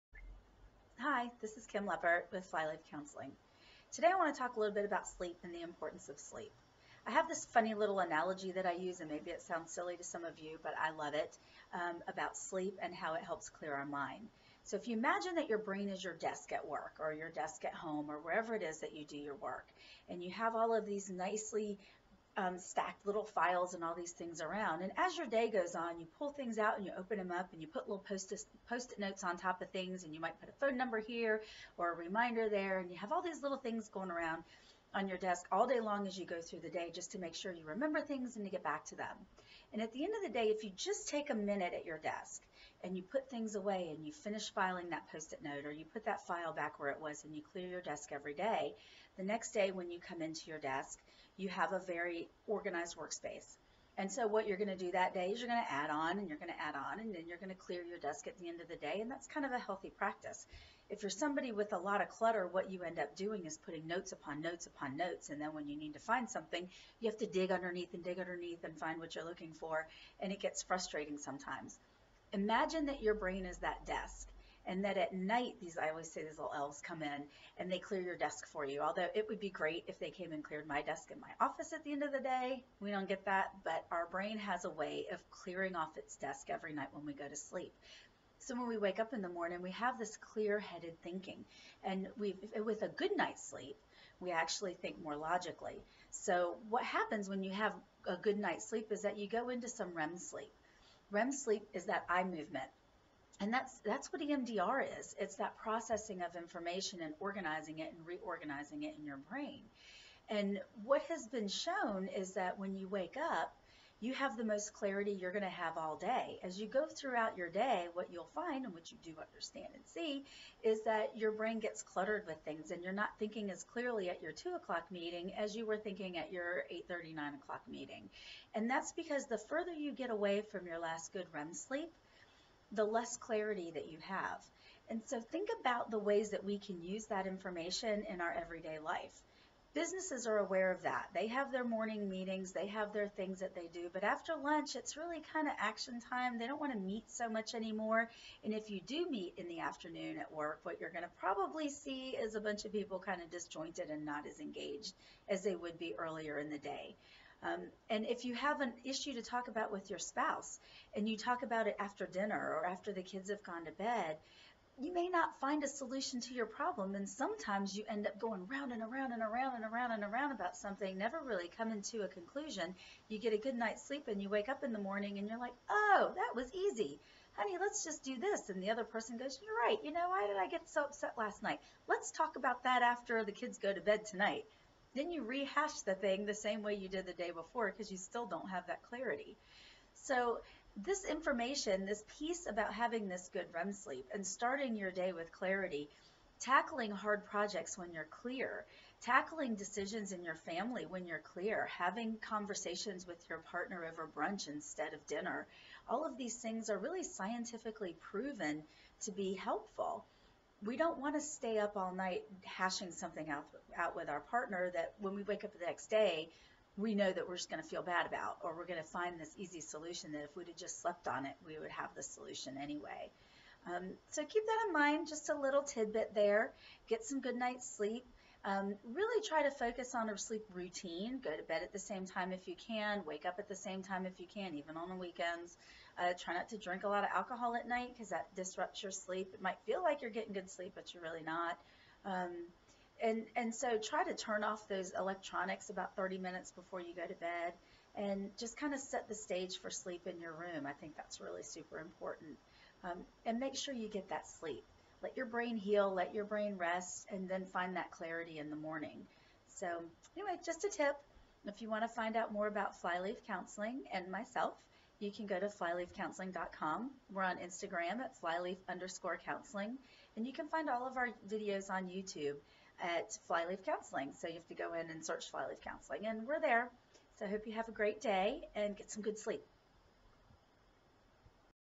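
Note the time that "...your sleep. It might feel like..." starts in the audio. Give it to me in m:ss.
3:58.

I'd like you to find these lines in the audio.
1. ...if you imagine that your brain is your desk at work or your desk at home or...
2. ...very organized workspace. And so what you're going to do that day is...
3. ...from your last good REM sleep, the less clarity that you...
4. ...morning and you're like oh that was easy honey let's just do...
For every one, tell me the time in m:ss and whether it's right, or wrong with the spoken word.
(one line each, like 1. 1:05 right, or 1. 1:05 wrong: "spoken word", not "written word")
1. 0:14 right
2. 0:51 right
3. 2:10 right
4. 2:54 right.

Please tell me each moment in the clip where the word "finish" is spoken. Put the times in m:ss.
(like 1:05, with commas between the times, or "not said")
0:44.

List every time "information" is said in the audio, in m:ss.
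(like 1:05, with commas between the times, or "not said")
1:46, 2:17, 3:11.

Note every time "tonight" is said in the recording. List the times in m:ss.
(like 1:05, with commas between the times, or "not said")
3:04.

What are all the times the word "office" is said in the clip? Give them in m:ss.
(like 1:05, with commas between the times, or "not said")
1:21.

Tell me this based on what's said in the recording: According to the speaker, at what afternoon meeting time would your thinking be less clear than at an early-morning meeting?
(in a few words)
2 o'clock.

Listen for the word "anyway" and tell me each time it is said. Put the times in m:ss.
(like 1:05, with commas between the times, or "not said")
3:42, 4:20.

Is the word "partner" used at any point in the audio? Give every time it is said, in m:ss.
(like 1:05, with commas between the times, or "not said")
3:23, 3:34.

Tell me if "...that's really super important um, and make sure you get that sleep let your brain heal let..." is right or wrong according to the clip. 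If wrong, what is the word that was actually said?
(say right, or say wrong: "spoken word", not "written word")
right.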